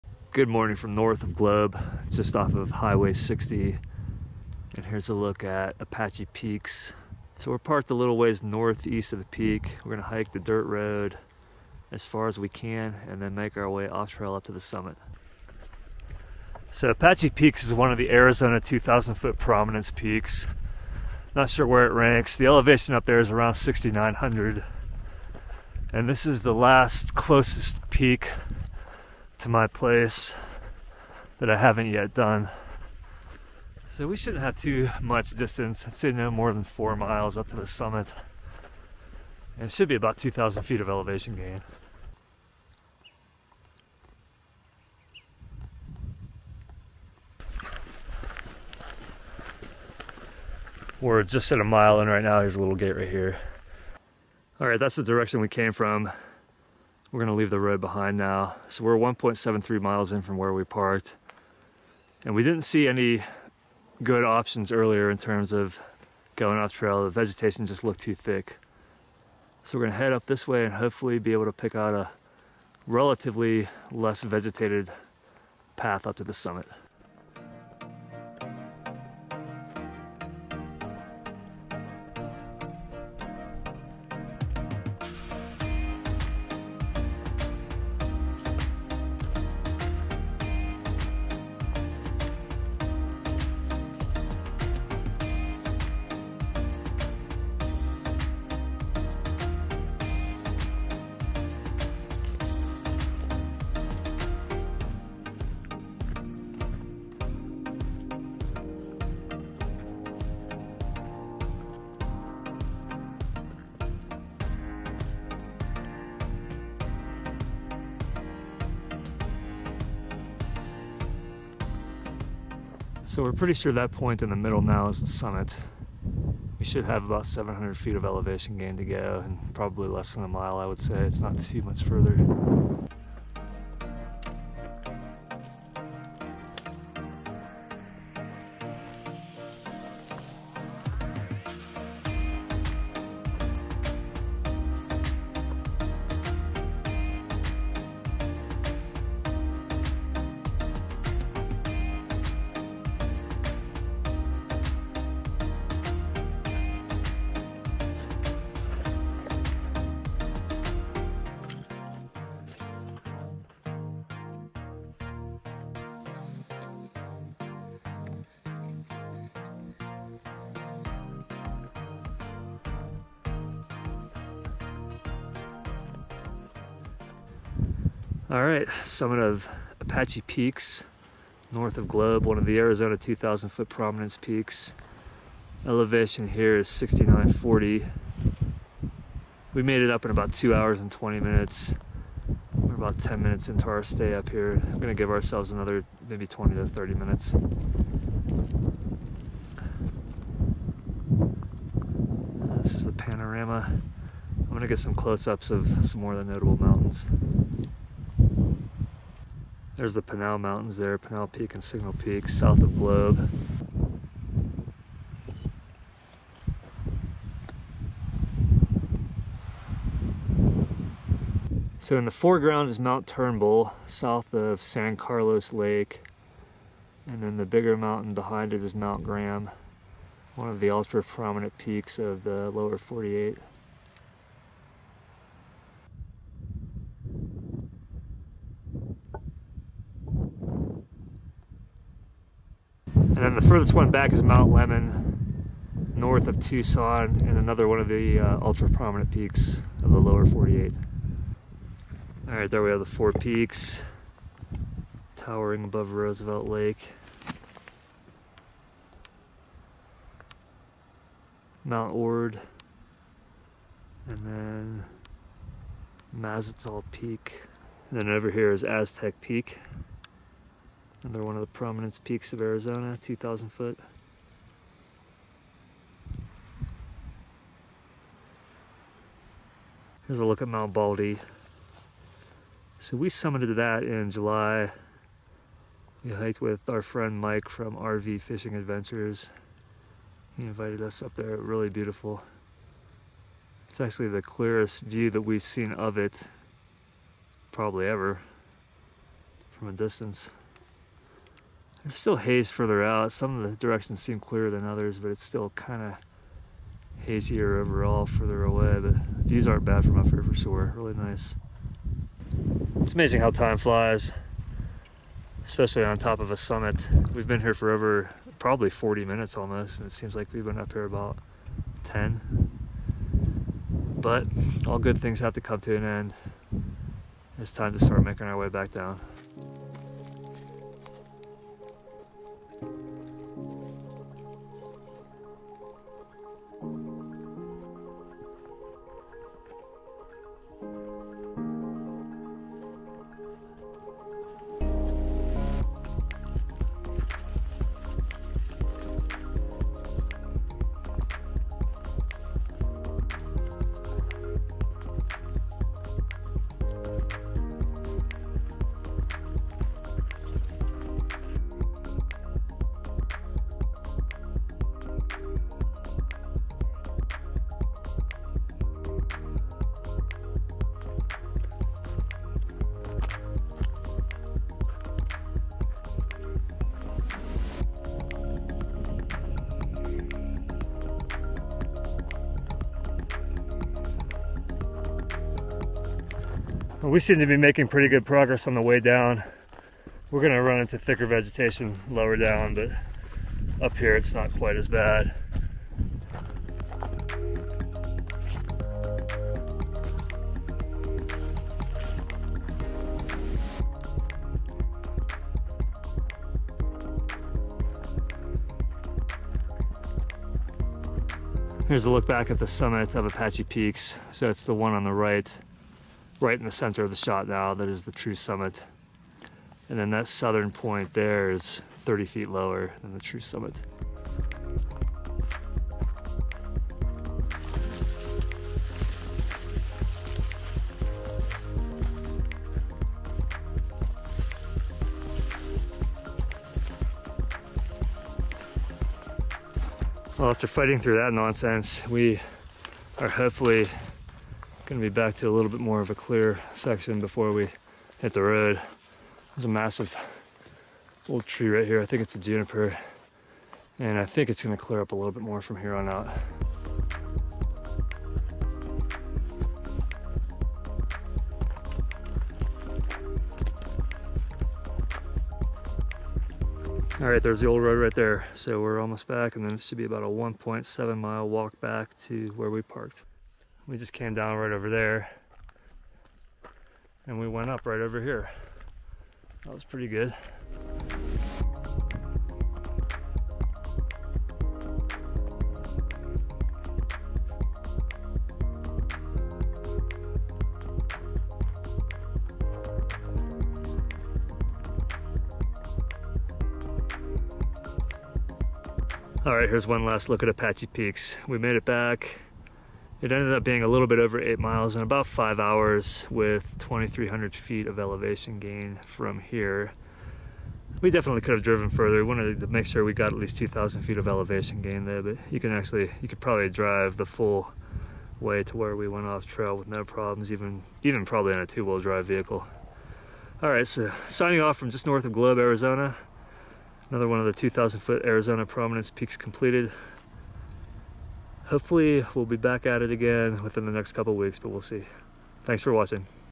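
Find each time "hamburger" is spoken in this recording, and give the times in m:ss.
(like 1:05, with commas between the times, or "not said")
not said.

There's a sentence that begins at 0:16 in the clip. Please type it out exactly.
So Apache Peaks is one of the Arizona 2,000 foot prominence peaks.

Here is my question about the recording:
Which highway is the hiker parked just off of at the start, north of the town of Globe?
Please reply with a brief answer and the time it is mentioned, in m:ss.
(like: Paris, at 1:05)
Highway 60, at 0:02.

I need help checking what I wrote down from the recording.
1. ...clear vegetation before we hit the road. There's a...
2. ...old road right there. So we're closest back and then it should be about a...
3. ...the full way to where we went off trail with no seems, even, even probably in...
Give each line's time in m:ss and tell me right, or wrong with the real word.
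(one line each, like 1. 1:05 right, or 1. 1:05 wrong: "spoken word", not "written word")
1. 7:25 wrong: "section", not "vegetation"
2. 7:47 wrong: "almost", not "closest"
3. 8:36 wrong: "problems", not "seems".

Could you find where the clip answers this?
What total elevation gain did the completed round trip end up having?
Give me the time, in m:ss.
8:26.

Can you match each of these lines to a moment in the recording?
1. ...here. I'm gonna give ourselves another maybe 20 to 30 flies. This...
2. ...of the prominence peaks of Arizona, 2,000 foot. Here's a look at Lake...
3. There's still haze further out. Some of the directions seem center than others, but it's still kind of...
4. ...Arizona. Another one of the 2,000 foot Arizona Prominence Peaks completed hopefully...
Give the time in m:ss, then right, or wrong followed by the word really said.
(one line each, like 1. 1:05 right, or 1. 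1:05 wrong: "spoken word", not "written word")
1. 3:14 wrong: "minutes", not "flies"
2. 4:31 wrong: "Mount", not "Lake"
3. 5:01 wrong: "clearer", not "center"
4. 8:45 right.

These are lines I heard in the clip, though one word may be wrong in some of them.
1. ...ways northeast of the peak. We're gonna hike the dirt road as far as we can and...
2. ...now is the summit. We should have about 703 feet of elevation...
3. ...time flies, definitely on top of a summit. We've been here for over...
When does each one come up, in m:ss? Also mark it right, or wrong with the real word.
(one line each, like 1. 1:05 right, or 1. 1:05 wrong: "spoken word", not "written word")
1. 0:08 right
2. 2:04 wrong: "700", not "703"
3. 5:13 wrong: "especially", not "definitely".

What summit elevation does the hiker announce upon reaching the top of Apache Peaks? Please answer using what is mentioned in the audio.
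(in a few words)
6940.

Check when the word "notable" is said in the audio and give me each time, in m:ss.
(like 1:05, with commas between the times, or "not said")
3:26.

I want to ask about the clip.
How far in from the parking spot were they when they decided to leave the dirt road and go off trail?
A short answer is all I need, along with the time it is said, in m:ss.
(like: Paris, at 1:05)
1.73 miles, at 0:58.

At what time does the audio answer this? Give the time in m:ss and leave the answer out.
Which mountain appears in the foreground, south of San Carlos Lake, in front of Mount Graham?
3:42.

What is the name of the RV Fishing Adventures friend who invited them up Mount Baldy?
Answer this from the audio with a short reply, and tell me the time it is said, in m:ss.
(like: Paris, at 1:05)
Mike, at 4:47.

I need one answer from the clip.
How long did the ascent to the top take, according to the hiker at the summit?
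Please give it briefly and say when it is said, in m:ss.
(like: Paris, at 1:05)
2 hours and 20 minutes, at 3:10.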